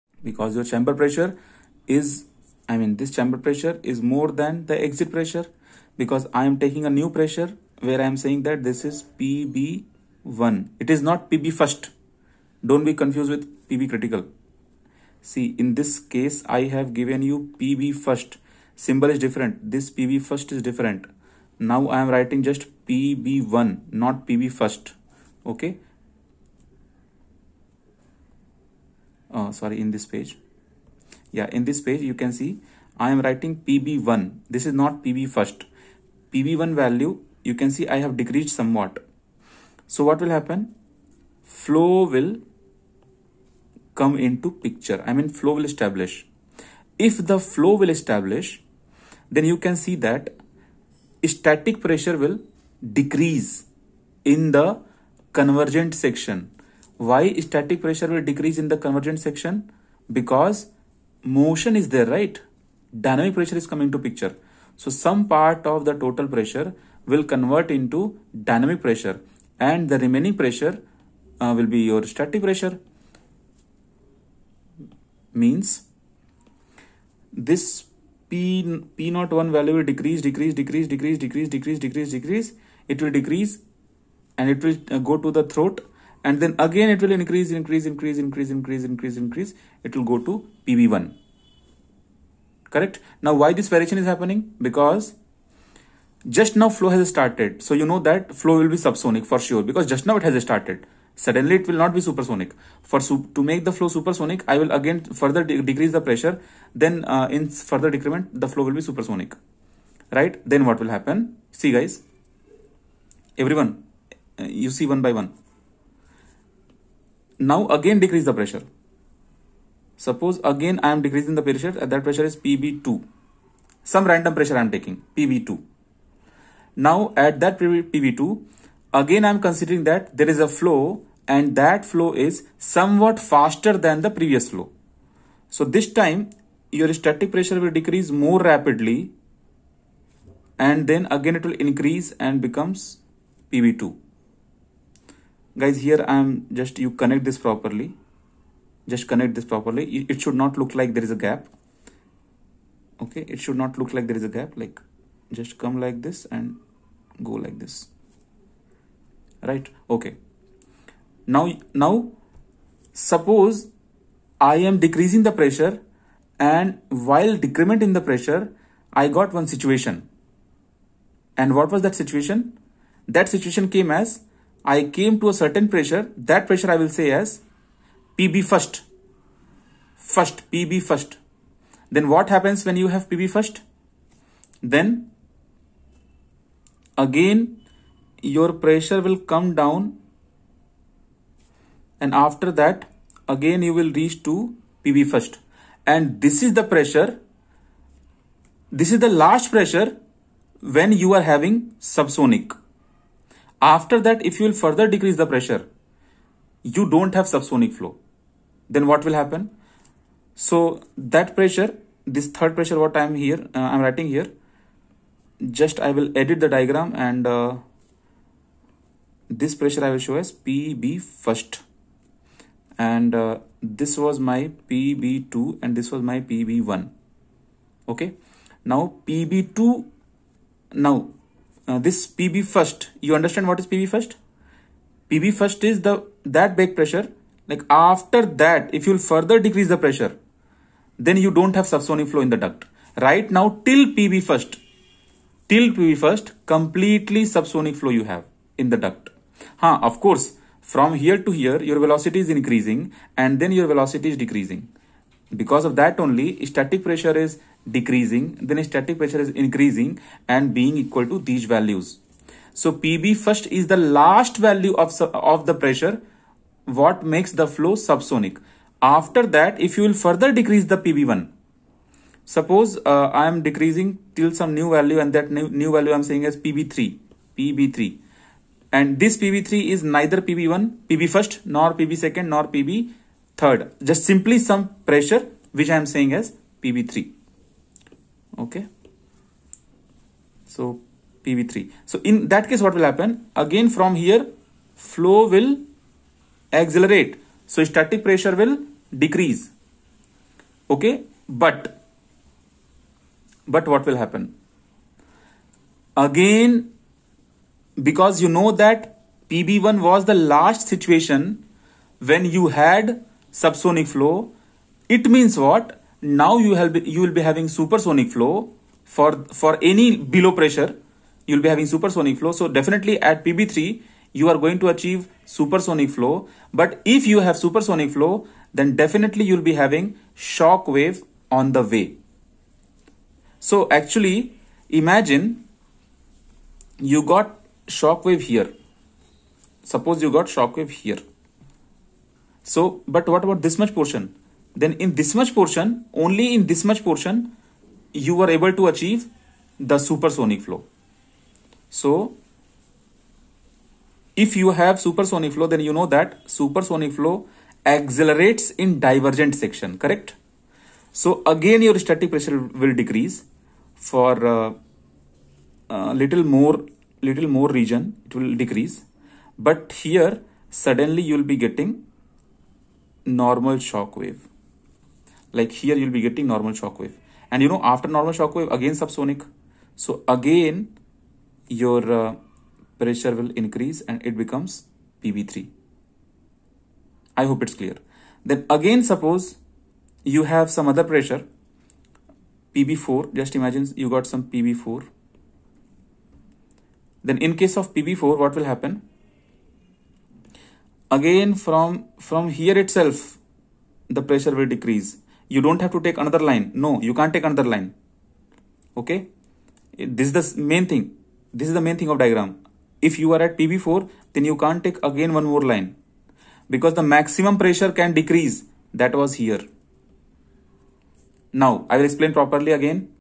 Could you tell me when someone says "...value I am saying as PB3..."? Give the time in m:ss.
4:35.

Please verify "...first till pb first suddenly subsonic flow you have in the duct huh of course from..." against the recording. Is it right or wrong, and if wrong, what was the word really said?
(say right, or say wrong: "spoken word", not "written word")
wrong: "completely", not "suddenly".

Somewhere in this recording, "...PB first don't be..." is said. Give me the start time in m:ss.
0:11.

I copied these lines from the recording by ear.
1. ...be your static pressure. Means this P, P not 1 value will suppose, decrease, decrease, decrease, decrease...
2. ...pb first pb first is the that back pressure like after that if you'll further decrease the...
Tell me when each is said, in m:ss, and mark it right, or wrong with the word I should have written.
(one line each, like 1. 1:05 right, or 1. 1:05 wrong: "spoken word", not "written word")
1. 1:11 wrong: "decrease", not "suppose"
2. 3:53 right.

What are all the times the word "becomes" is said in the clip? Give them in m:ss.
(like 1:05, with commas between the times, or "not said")
2:22, 6:24.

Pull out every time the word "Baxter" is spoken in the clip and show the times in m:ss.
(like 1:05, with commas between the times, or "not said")
not said.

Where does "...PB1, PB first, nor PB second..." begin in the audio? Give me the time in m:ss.
4:40.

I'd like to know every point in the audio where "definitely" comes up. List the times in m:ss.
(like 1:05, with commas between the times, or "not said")
5:22, 5:28.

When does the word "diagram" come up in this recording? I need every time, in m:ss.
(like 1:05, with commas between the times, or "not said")
3:36, 6:52.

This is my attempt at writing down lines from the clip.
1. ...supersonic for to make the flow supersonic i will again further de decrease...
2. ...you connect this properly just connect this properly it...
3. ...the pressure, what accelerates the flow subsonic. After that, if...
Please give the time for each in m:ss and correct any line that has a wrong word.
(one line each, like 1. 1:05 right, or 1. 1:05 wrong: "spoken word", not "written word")
1. 1:42 right
2. 2:26 right
3. 4:25 wrong: "makes", not "accelerates".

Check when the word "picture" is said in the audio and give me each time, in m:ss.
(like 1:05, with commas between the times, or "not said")
0:44, 1:03.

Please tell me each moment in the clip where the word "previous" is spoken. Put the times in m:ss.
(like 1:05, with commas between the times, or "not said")
2:14.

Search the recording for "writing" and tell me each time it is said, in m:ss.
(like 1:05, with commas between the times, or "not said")
0:22, 0:33, 3:33.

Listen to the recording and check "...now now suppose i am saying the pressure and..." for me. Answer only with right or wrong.
wrong.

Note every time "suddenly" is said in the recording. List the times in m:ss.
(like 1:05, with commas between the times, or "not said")
1:41, 6:10.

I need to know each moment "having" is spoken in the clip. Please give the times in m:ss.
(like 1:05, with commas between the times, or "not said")
3:21, 5:17, 5:21, 5:29.